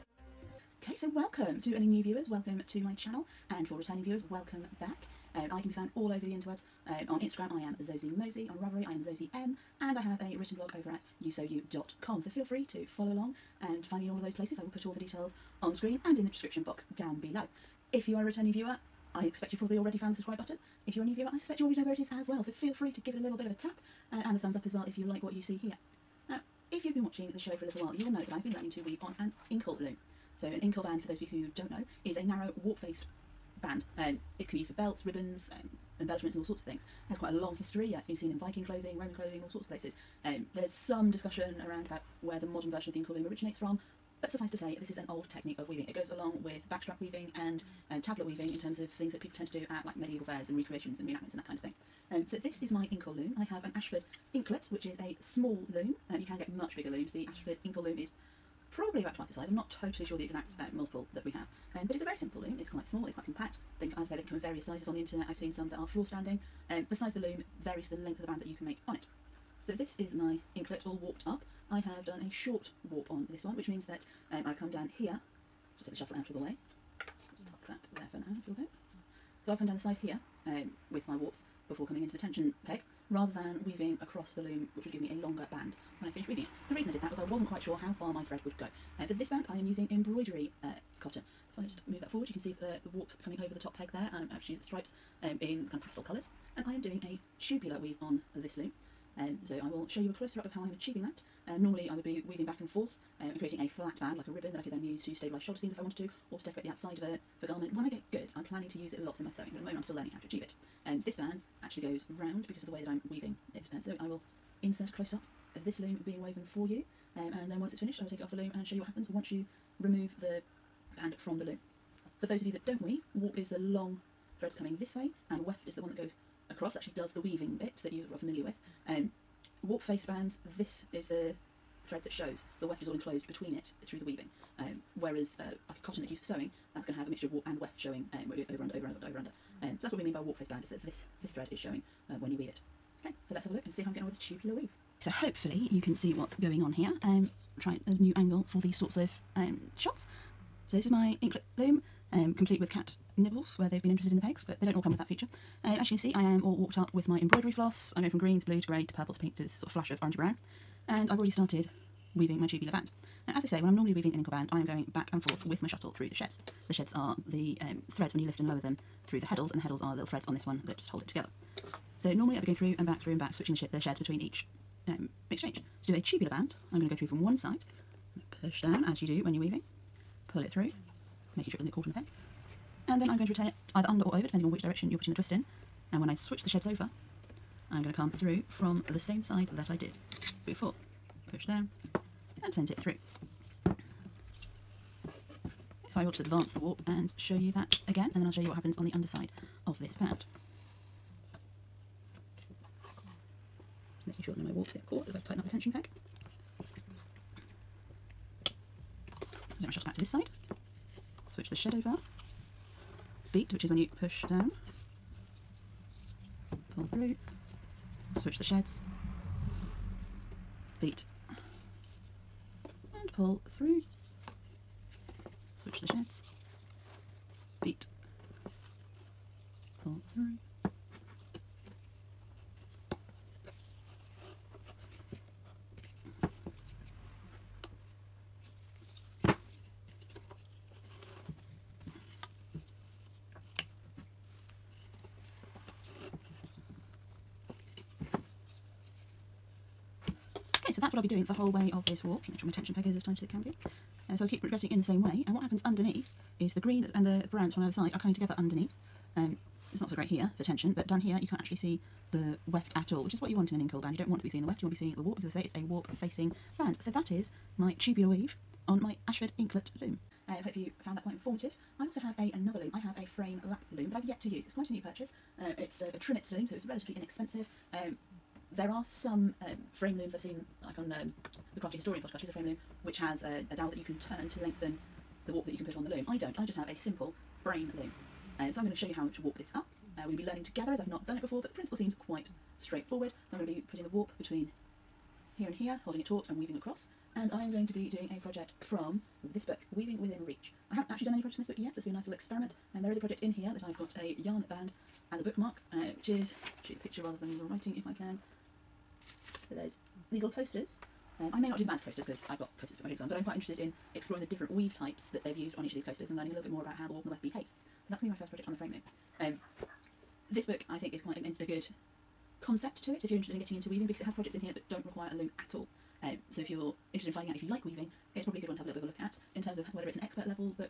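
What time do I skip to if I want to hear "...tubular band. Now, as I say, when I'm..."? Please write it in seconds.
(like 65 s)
162 s.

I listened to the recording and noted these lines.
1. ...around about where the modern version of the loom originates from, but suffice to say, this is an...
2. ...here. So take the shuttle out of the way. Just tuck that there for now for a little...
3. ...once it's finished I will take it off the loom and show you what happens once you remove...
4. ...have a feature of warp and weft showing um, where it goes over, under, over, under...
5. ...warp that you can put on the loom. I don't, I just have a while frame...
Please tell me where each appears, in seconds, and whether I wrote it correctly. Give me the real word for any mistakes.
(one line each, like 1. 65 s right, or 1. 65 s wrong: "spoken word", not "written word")
1. 41 s right
2. 74 s right
3. 117 s right
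4. 136 s wrong: "mixture", not "feature"
5. 285 s wrong: "simple", not "while".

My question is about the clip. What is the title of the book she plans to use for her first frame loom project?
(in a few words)
Weaving Within Reach.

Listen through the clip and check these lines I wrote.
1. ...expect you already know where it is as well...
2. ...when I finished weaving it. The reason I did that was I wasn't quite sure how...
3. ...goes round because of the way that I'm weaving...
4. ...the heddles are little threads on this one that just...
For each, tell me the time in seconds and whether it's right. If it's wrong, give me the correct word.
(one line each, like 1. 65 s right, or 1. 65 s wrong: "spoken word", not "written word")
1. 21 s wrong: "suspect", not "expect"
2. 85 s right
3. 111 s right
4. 169 s right.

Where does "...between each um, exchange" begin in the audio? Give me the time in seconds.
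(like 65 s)
173 s.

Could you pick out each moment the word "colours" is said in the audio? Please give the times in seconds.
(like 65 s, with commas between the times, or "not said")
96 s.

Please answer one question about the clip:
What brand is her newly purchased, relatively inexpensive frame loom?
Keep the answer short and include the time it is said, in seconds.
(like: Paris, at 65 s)
Trimits, at 275 s.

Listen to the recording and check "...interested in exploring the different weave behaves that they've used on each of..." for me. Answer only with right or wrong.
wrong.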